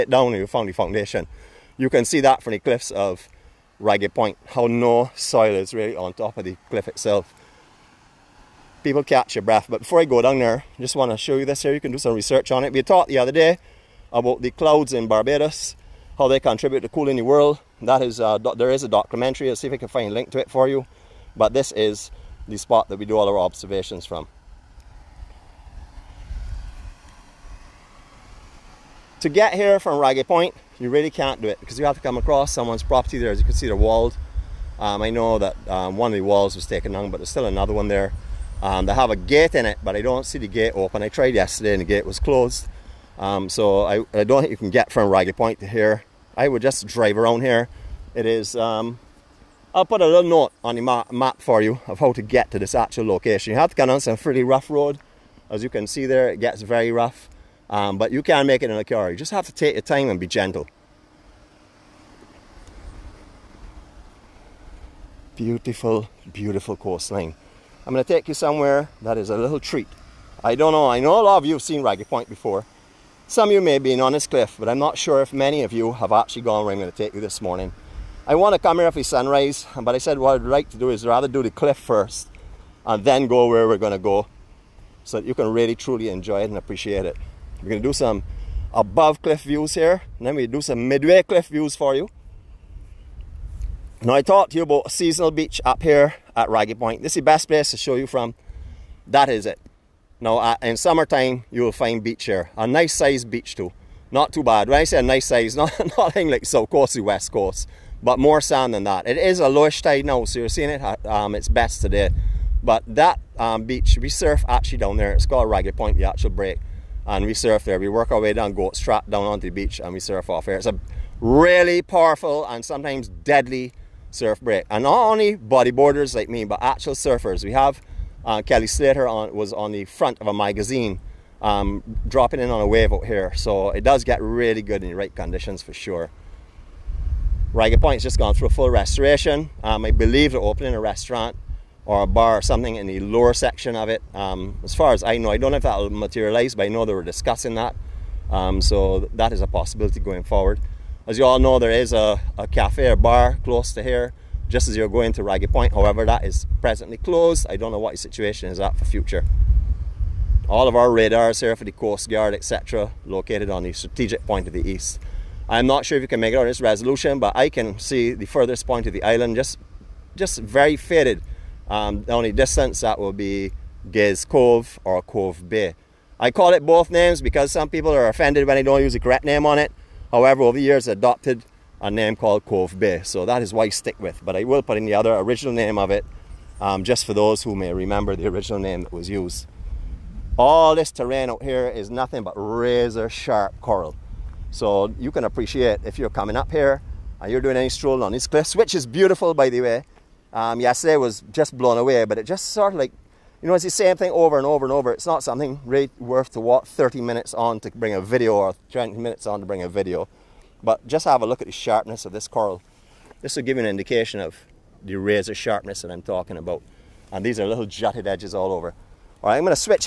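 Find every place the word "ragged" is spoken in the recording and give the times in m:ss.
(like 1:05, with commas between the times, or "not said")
0:03, 0:29, 0:45, 1:11, 1:36, 1:55, 2:17, 2:35.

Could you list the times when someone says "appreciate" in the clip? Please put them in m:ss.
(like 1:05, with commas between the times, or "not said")
1:26, 3:15.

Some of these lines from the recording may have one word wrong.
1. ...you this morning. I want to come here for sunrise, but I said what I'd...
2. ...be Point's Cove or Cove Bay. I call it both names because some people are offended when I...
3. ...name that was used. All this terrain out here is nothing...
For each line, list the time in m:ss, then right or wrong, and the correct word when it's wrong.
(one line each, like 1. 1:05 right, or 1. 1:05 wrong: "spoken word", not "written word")
1. 1:17 right
2. 2:53 wrong: "Gay", not "Point"
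3. 3:08 right.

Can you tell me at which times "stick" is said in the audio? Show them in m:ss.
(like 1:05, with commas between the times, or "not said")
3:03.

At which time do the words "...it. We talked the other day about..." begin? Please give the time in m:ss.
0:12.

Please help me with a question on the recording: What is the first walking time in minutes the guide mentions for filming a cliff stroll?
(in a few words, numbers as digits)
30.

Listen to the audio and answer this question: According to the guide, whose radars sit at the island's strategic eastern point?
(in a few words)
Coast Guard.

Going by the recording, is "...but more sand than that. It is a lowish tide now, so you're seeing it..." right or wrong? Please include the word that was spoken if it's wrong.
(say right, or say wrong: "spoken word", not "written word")
right.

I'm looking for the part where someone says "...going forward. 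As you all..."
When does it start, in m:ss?
2:29.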